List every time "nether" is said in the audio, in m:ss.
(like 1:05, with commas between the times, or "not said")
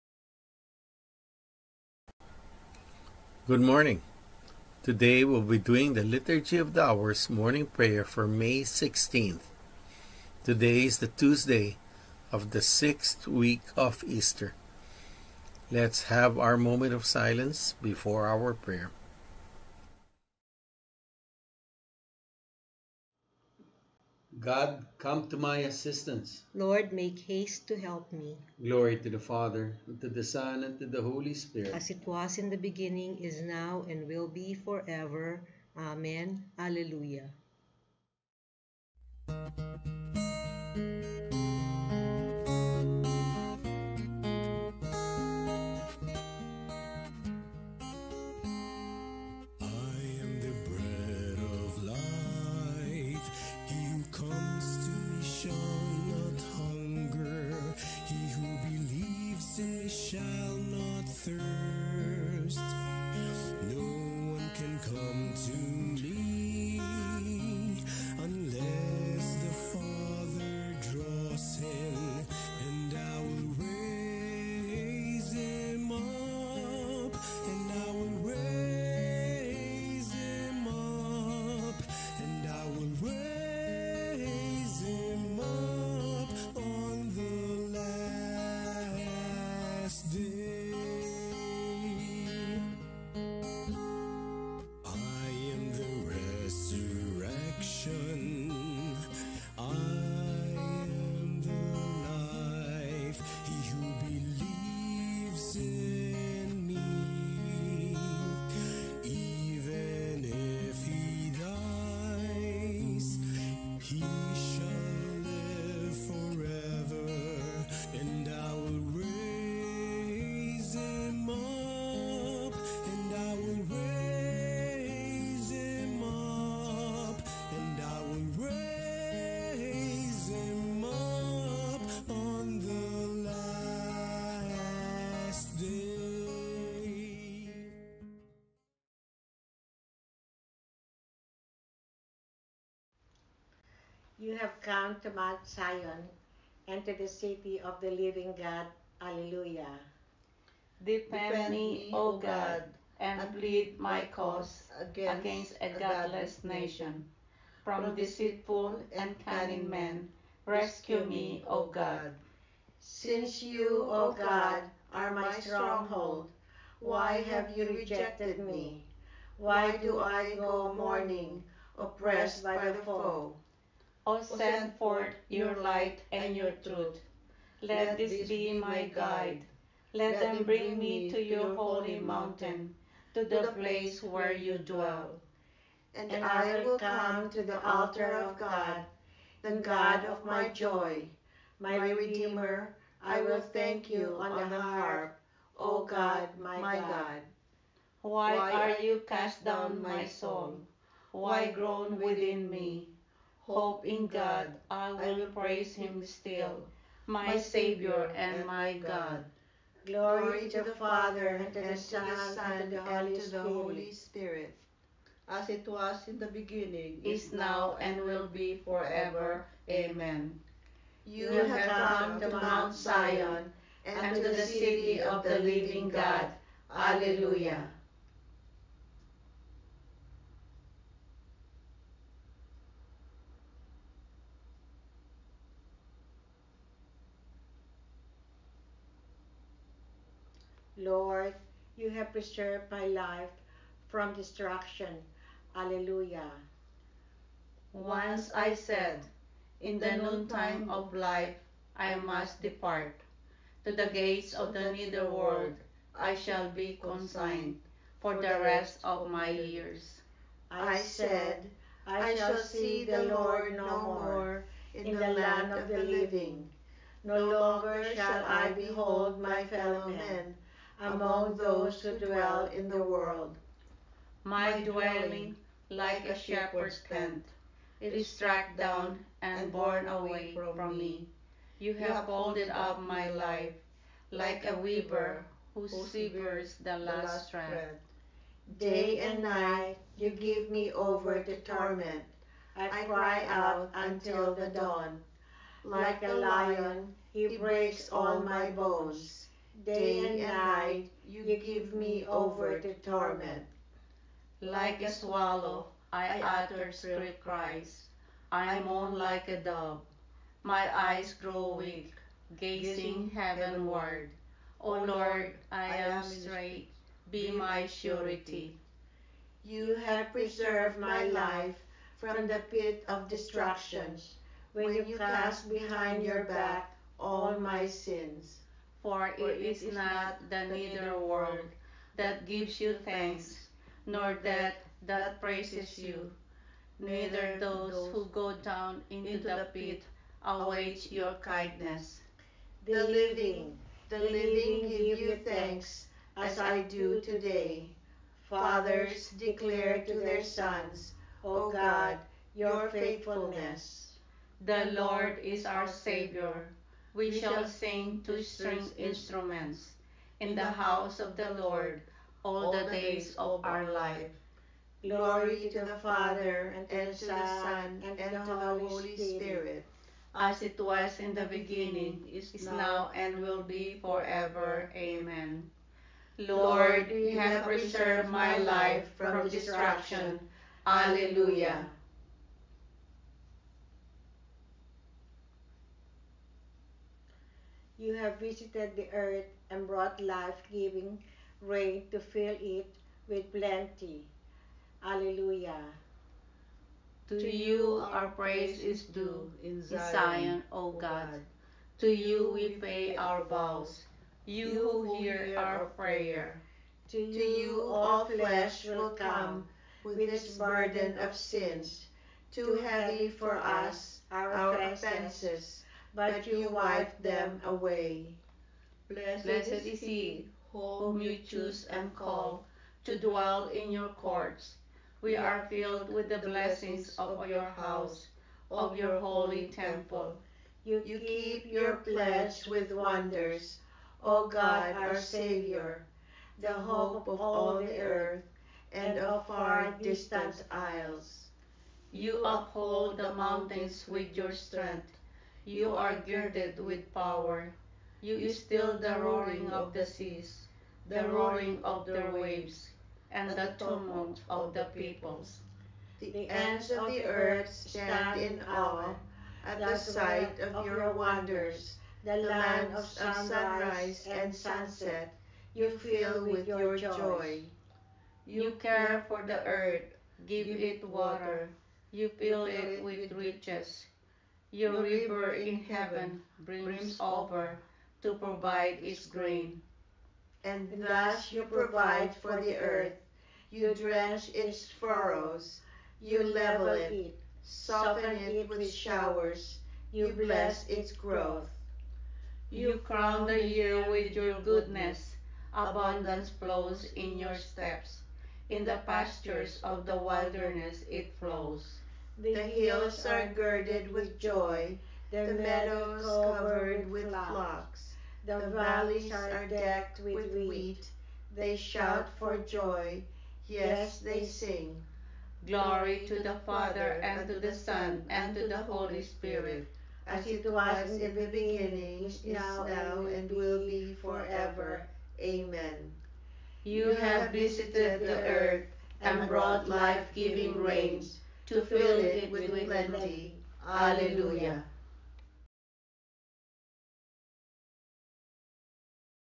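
4:14.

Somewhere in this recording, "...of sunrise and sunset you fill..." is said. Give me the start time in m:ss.
7:42.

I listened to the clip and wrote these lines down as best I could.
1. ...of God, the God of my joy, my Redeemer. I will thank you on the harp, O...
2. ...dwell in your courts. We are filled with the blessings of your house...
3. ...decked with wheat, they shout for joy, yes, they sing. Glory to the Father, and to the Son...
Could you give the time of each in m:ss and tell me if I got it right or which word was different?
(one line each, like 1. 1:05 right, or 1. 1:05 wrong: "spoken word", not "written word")
1. 3:08 right
2. 7:02 right
3. 8:29 right.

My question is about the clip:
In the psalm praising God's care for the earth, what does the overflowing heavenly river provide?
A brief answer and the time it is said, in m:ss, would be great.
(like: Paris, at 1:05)
its grain, at 7:58.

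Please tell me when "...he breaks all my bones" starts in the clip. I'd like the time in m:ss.
4:57.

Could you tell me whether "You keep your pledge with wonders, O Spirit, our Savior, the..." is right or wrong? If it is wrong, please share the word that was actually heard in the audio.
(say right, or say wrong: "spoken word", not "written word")
wrong: "God", not "Spirit".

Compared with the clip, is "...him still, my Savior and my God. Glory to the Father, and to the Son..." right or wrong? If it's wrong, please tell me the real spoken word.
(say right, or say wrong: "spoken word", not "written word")
right.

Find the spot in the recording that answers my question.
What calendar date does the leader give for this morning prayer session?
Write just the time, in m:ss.
0:08.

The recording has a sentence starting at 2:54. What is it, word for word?
O send forth your light and your truth.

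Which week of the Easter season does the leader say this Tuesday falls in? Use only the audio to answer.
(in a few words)
sixth week.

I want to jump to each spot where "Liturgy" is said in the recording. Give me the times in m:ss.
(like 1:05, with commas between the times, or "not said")
0:06.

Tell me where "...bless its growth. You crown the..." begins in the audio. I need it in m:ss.
8:10.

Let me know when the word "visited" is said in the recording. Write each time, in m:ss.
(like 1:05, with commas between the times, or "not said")
6:28, 8:47.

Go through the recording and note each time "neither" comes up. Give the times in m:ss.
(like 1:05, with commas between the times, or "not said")
5:30, 5:36.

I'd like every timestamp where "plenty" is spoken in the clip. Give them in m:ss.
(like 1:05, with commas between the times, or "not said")
6:33, 8:52.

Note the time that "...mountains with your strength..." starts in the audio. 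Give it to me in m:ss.
7:23.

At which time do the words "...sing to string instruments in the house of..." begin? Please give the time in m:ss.
5:57.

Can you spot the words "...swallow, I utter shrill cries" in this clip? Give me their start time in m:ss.
5:04.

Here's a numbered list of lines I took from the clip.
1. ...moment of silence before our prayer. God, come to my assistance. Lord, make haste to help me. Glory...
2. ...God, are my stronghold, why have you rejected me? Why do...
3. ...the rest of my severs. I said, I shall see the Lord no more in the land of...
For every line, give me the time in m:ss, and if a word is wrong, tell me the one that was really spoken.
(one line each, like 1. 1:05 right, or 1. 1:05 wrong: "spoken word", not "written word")
1. 0:16 right
2. 2:44 right
3. 4:18 wrong: "years", not "severs".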